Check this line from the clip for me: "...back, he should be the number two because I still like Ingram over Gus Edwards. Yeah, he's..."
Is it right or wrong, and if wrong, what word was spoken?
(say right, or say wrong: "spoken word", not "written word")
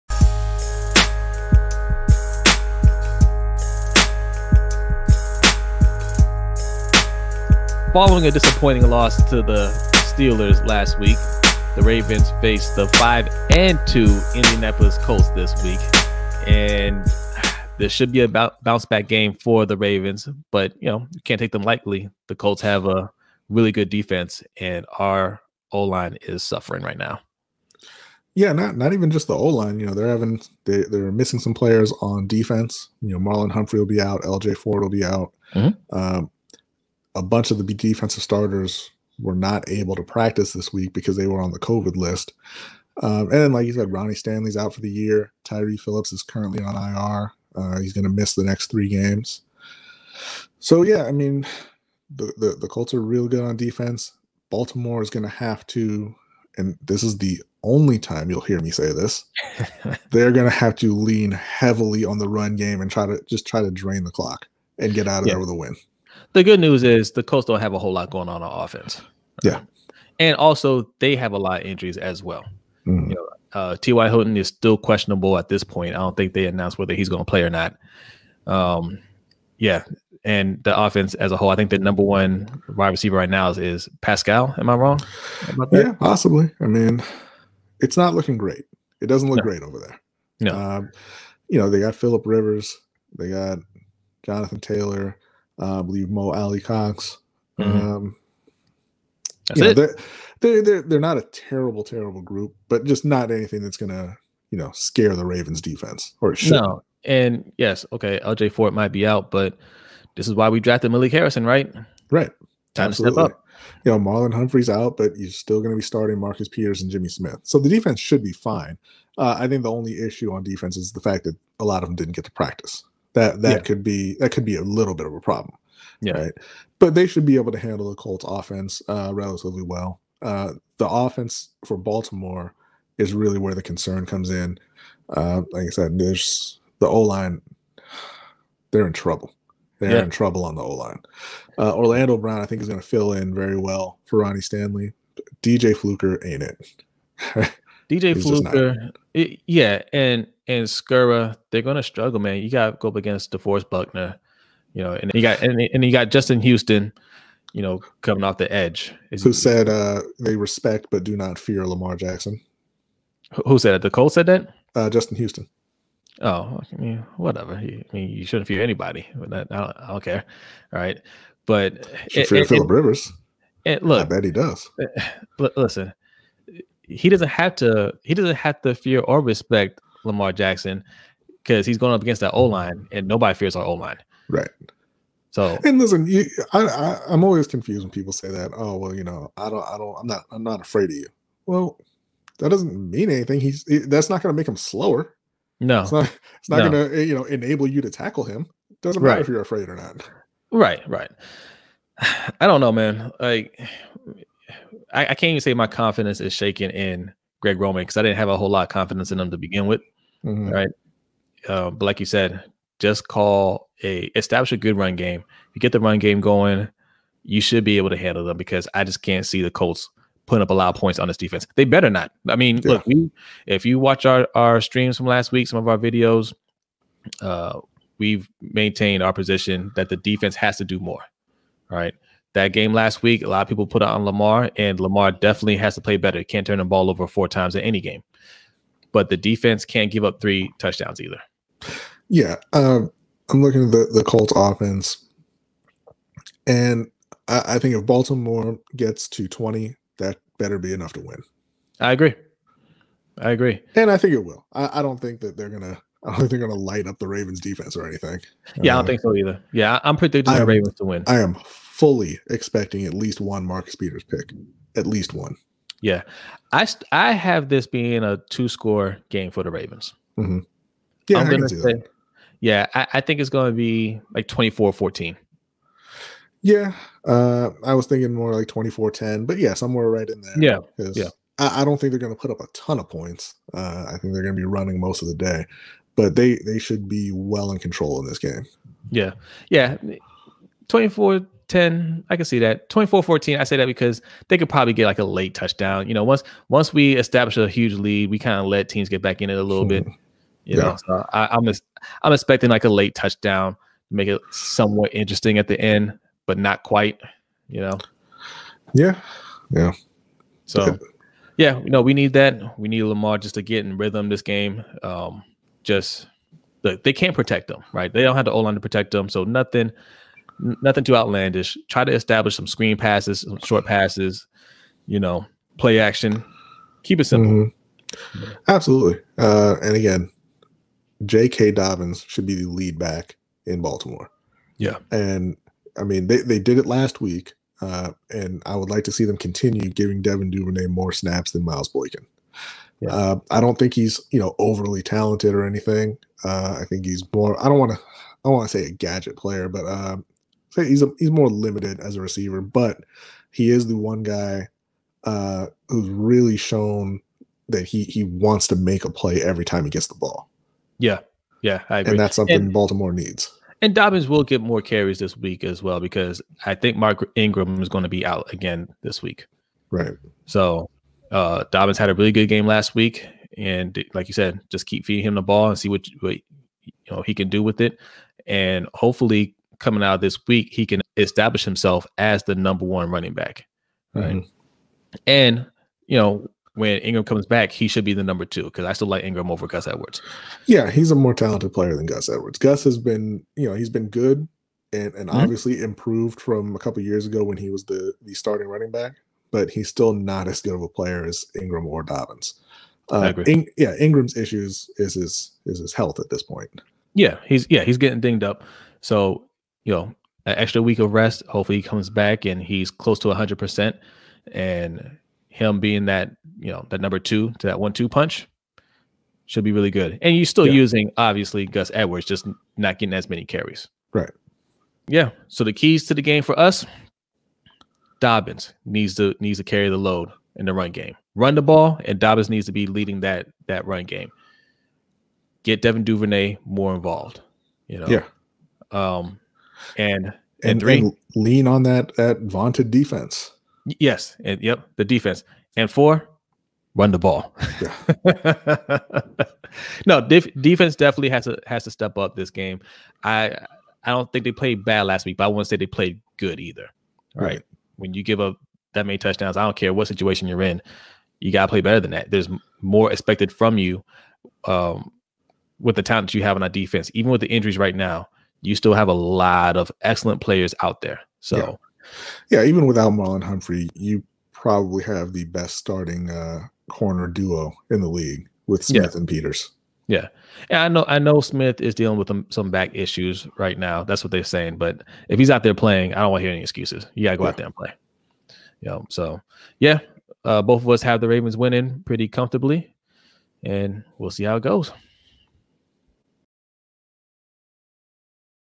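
right.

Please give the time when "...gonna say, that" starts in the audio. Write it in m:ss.
4:31.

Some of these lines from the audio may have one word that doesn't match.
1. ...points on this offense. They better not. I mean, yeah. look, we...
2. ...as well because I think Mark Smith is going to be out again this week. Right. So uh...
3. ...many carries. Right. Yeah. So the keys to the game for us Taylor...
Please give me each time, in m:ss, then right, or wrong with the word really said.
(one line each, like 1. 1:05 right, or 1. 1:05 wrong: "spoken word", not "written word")
1. 3:40 wrong: "defense", not "offense"
2. 6:05 wrong: "Ingram", not "Smith"
3. 7:03 wrong: "Dobbins", not "Taylor".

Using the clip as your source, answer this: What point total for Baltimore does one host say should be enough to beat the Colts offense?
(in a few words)
20.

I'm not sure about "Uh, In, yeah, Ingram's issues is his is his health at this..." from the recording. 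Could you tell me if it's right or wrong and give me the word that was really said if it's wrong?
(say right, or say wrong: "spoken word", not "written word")
right.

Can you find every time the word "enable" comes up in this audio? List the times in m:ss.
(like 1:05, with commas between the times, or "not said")
3:17.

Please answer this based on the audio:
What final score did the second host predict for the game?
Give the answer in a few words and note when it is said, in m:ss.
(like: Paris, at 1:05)
24-10, at 4:38.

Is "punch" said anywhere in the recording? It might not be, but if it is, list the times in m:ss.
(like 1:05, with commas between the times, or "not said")
6:57.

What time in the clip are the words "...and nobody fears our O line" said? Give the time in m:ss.
3:02.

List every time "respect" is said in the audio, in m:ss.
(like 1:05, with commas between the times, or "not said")
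2:40, 2:59.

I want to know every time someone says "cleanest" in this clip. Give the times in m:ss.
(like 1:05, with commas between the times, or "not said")
not said.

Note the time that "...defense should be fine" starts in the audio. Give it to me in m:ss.
1:57.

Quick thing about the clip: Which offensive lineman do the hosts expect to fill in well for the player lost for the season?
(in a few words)
Orlando Brown.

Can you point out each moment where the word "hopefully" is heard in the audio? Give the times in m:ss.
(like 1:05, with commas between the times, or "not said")
6:18, 6:51.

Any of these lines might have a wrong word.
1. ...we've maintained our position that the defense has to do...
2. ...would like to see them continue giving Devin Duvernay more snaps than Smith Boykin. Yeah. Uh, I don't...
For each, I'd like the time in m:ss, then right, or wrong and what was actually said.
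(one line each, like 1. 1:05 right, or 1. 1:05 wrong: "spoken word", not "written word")
1. 3:47 right
2. 5:38 wrong: "Miles", not "Smith".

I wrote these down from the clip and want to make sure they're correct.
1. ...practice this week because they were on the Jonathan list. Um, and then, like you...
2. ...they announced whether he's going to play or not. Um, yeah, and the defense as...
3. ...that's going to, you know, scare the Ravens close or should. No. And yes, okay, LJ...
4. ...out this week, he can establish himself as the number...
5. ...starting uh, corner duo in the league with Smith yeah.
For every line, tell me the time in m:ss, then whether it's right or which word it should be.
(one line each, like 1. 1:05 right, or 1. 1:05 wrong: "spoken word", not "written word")
1. 0:40 wrong: "COVID", not "Jonathan"
2. 1:16 wrong: "offense", not "defense"
3. 1:43 wrong: "defense", not "close"
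4. 6:19 right
5. 7:55 right.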